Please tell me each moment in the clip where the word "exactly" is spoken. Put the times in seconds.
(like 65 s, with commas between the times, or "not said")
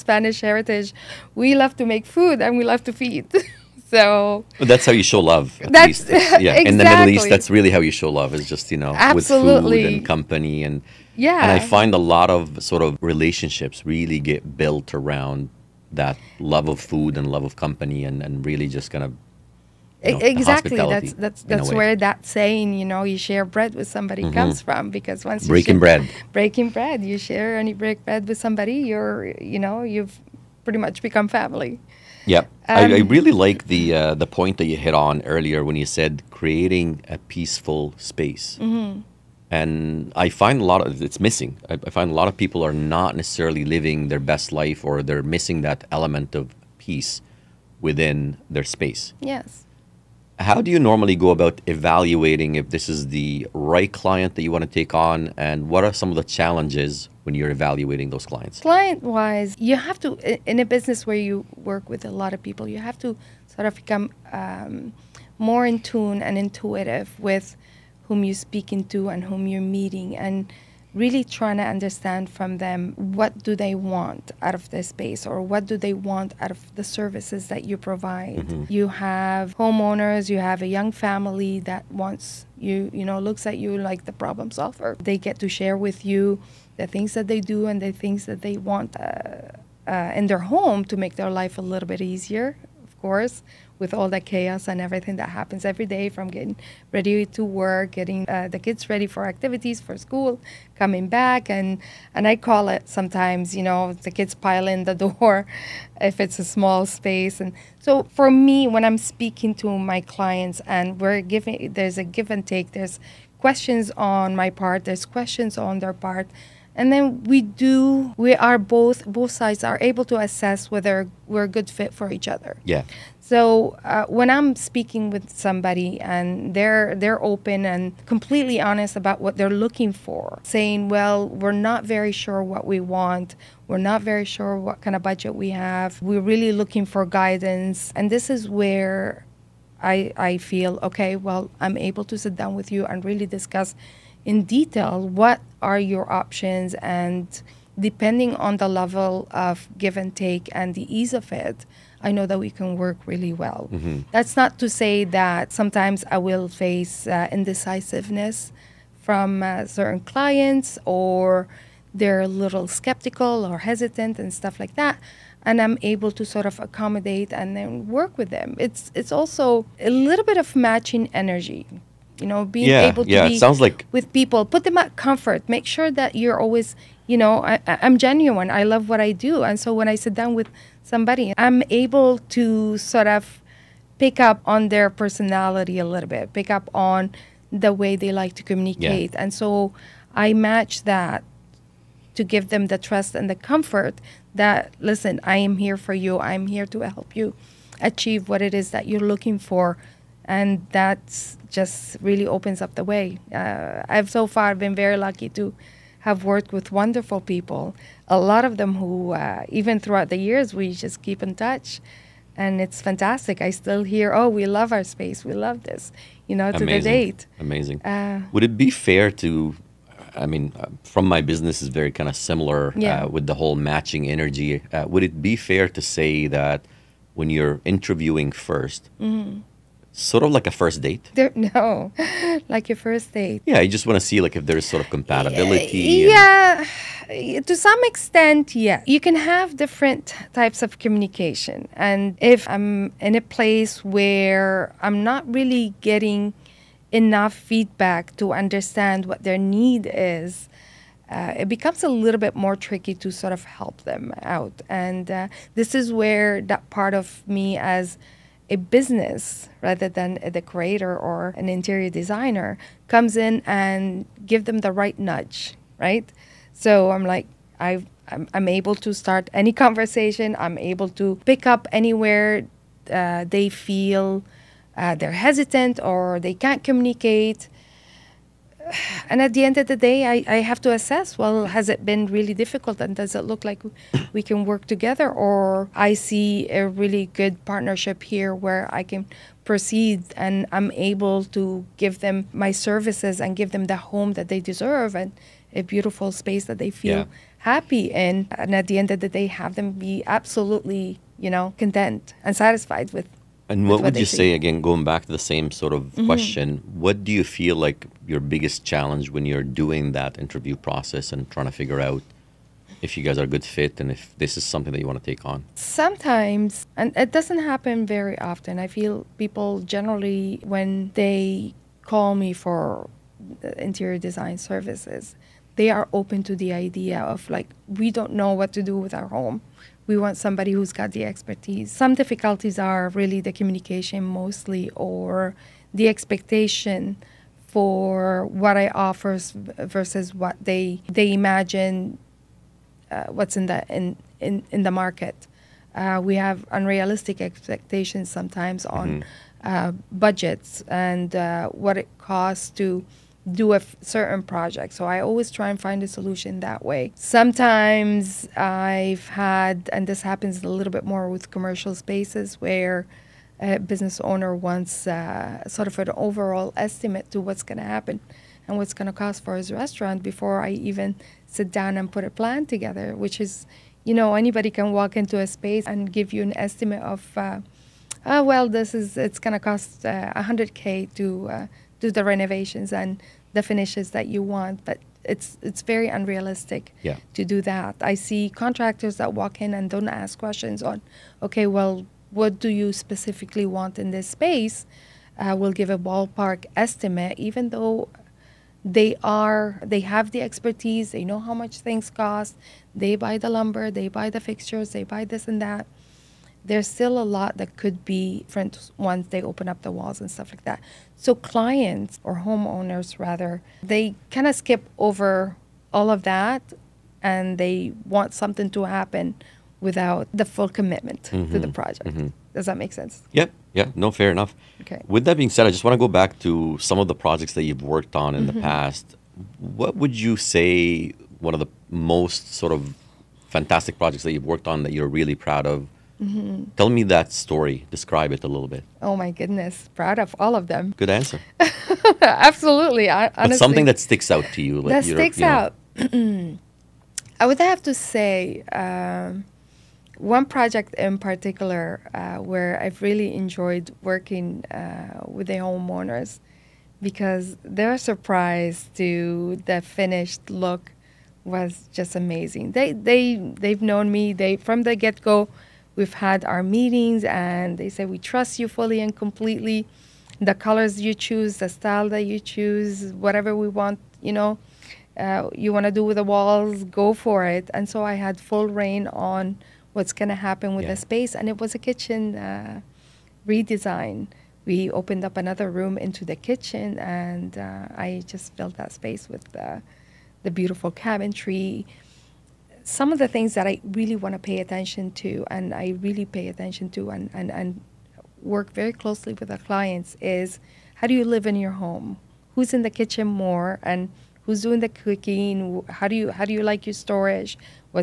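6 s, 20 s.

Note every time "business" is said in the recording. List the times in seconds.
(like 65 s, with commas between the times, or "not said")
60 s, 221 s, 258 s, 363 s.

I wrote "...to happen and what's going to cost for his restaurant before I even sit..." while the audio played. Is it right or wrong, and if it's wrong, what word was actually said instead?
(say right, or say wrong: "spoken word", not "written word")
right.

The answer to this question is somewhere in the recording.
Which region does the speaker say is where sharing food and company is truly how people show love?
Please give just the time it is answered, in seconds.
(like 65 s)
6 s.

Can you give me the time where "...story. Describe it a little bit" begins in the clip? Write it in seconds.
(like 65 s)
437 s.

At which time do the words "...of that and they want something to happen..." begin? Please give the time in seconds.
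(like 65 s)
415 s.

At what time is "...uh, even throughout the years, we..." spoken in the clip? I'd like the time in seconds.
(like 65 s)
209 s.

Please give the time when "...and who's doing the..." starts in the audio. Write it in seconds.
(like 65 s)
503 s.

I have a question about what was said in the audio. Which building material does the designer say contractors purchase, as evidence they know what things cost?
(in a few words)
lumber.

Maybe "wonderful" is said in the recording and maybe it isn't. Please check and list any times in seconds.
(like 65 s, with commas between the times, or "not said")
206 s.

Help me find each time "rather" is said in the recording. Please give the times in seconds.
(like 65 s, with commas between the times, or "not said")
259 s, 412 s.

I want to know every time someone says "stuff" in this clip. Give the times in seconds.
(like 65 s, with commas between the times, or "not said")
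164 s, 410 s.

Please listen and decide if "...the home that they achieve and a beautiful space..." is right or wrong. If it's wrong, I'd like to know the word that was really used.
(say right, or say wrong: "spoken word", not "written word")
wrong: "deserve", not "achieve".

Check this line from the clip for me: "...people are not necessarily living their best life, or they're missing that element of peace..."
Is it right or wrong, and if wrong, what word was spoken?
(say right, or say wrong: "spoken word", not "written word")
right.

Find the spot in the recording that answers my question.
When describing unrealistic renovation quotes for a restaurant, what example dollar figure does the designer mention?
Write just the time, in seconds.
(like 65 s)
380 s.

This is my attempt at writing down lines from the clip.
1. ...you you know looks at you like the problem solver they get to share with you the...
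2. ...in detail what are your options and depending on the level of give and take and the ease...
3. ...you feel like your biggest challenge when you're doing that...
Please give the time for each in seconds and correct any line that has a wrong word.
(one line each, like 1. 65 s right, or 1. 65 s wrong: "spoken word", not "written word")
1. 82 s right
2. 144 s right
3. 307 s right.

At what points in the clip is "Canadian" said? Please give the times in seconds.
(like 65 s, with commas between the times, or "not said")
not said.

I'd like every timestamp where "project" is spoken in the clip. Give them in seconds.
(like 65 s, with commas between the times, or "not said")
354 s, 421 s, 426 s, 433 s, 450 s.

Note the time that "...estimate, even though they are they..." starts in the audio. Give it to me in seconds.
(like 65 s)
396 s.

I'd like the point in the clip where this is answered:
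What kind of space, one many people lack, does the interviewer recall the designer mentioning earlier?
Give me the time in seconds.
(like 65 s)
37 s.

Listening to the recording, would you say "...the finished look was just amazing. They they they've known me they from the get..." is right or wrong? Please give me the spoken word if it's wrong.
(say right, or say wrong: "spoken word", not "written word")
right.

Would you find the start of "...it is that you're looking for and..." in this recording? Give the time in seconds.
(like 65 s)
198 s.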